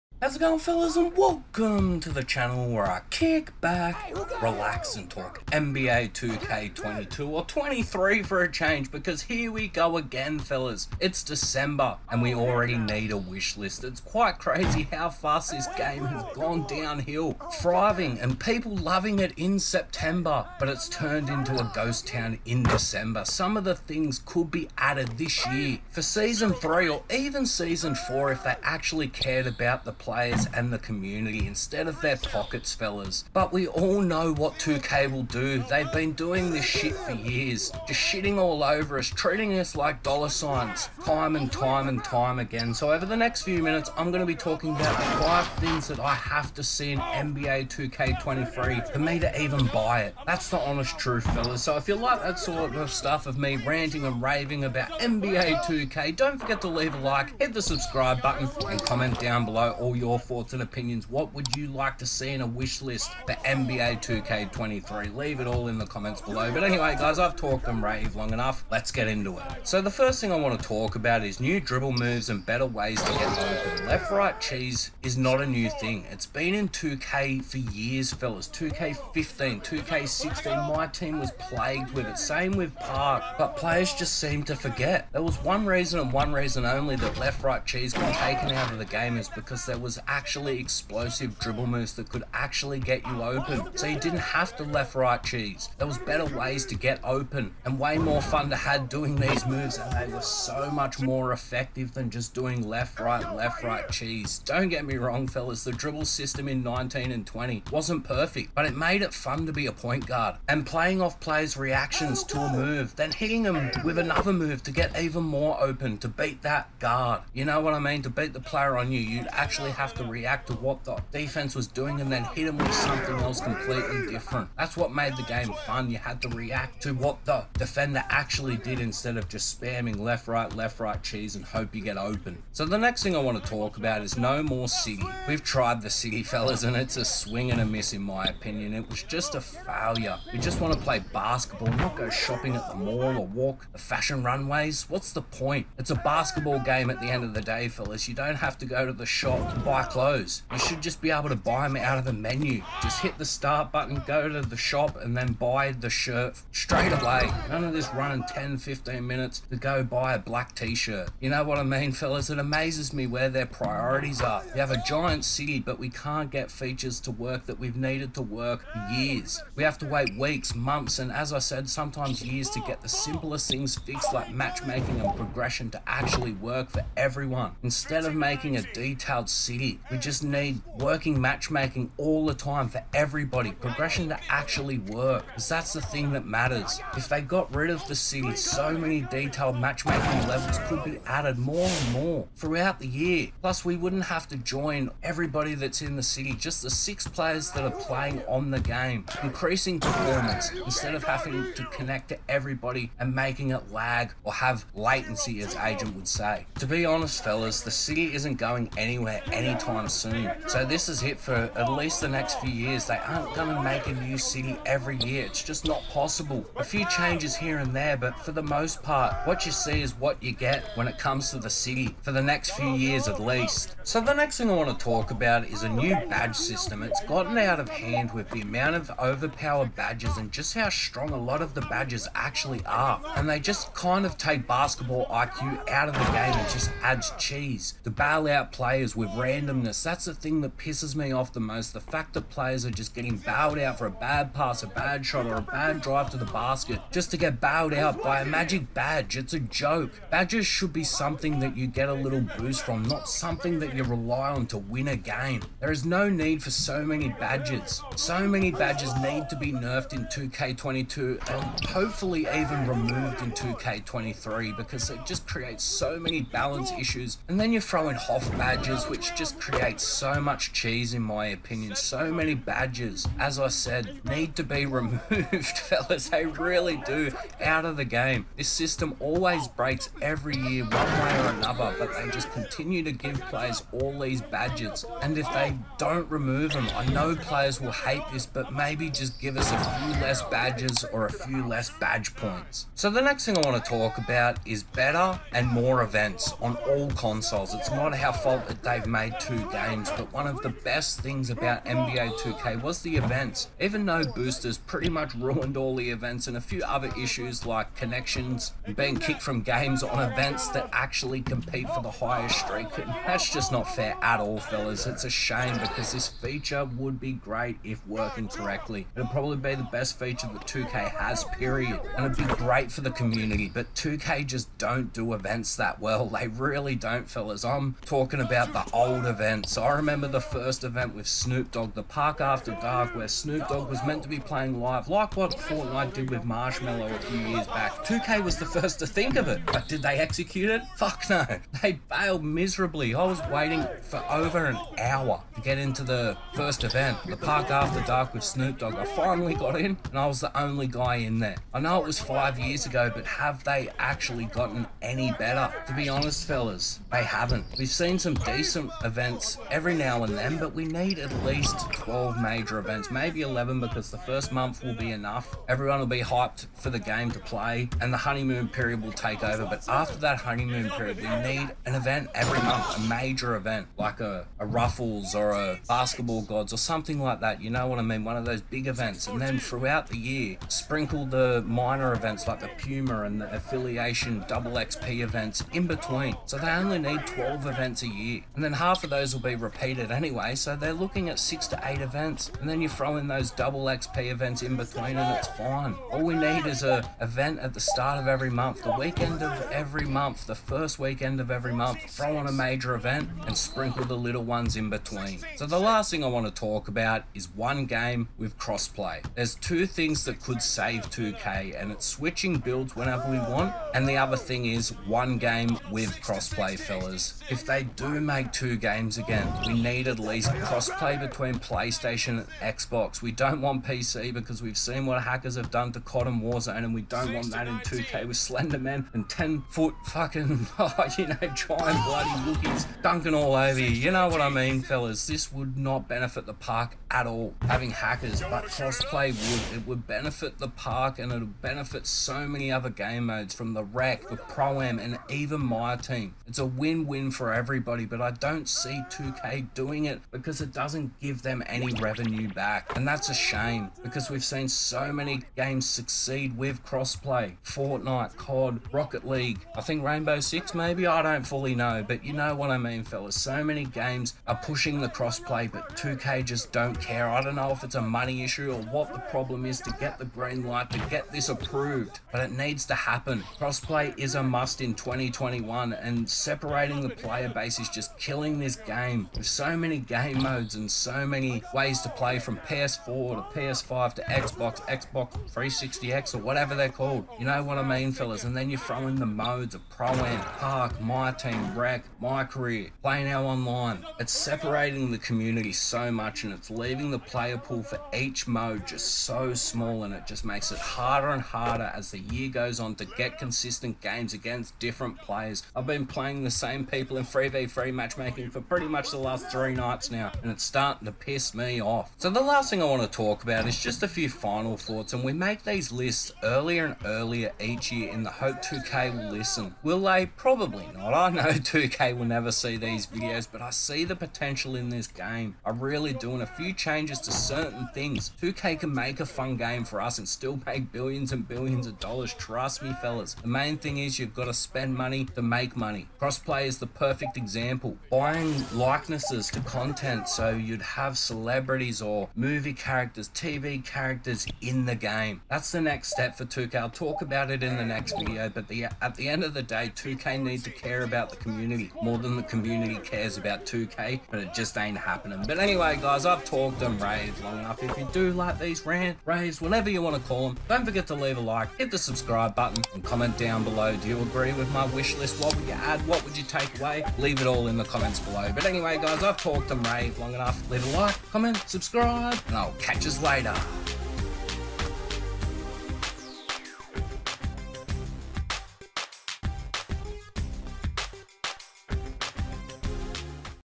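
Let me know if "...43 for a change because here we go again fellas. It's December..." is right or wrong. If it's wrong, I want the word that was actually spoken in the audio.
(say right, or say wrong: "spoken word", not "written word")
wrong: "23", not "43".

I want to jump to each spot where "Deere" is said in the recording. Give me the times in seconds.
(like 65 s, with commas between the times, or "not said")
not said.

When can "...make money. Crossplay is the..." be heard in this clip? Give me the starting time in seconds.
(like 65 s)
535 s.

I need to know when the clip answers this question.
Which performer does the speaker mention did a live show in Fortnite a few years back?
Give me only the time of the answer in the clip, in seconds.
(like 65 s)
336 s.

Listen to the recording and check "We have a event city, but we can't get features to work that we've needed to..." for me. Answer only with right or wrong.
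wrong.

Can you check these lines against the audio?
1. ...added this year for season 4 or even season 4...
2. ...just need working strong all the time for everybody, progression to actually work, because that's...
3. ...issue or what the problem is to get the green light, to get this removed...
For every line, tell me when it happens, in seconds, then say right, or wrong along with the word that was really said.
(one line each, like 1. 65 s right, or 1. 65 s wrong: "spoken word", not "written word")
1. 24 s wrong: "3", not "4"
2. 179 s wrong: "matchmaking", not "strong"
3. 468 s wrong: "approved", not "removed".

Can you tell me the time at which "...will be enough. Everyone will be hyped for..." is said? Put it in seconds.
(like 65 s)
364 s.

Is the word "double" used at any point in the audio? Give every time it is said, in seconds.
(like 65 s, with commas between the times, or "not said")
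384 s, 393 s.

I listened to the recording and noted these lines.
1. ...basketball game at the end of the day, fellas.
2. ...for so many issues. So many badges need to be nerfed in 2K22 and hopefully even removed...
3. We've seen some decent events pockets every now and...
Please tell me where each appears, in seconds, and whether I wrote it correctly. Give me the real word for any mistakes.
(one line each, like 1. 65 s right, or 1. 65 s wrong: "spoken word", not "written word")
1. 145 s right
2. 256 s wrong: "badges", not "issues"
3. 357 s wrong: "events", not "pockets".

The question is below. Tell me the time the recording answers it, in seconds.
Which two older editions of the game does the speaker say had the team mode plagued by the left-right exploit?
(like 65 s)
78 s.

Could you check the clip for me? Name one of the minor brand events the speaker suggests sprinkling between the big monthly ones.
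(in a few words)
Puma.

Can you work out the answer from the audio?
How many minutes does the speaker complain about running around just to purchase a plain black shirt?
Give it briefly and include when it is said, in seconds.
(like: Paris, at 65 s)
10, 15, at 158 s.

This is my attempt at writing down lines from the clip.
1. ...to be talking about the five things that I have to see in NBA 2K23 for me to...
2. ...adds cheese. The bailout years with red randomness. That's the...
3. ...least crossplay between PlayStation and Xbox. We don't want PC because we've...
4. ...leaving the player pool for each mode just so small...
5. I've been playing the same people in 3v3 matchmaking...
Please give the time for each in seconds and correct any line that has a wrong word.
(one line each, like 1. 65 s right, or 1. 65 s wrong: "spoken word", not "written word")
1. 44 s right
2. 236 s wrong: "players", not "years"
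3. 419 s right
4. 496 s right
5. 505 s right.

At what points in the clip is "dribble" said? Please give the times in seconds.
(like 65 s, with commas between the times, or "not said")
71 s, 91 s, 105 s.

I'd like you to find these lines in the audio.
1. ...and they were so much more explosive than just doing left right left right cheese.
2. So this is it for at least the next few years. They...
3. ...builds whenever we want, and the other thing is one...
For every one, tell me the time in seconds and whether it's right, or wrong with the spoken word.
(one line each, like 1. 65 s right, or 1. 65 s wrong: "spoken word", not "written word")
1. 99 s wrong: "effective", not "explosive"
2. 210 s right
3. 412 s right.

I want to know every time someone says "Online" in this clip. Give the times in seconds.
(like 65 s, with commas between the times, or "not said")
493 s.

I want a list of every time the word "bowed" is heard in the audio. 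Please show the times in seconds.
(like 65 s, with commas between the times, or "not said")
243 s, 247 s.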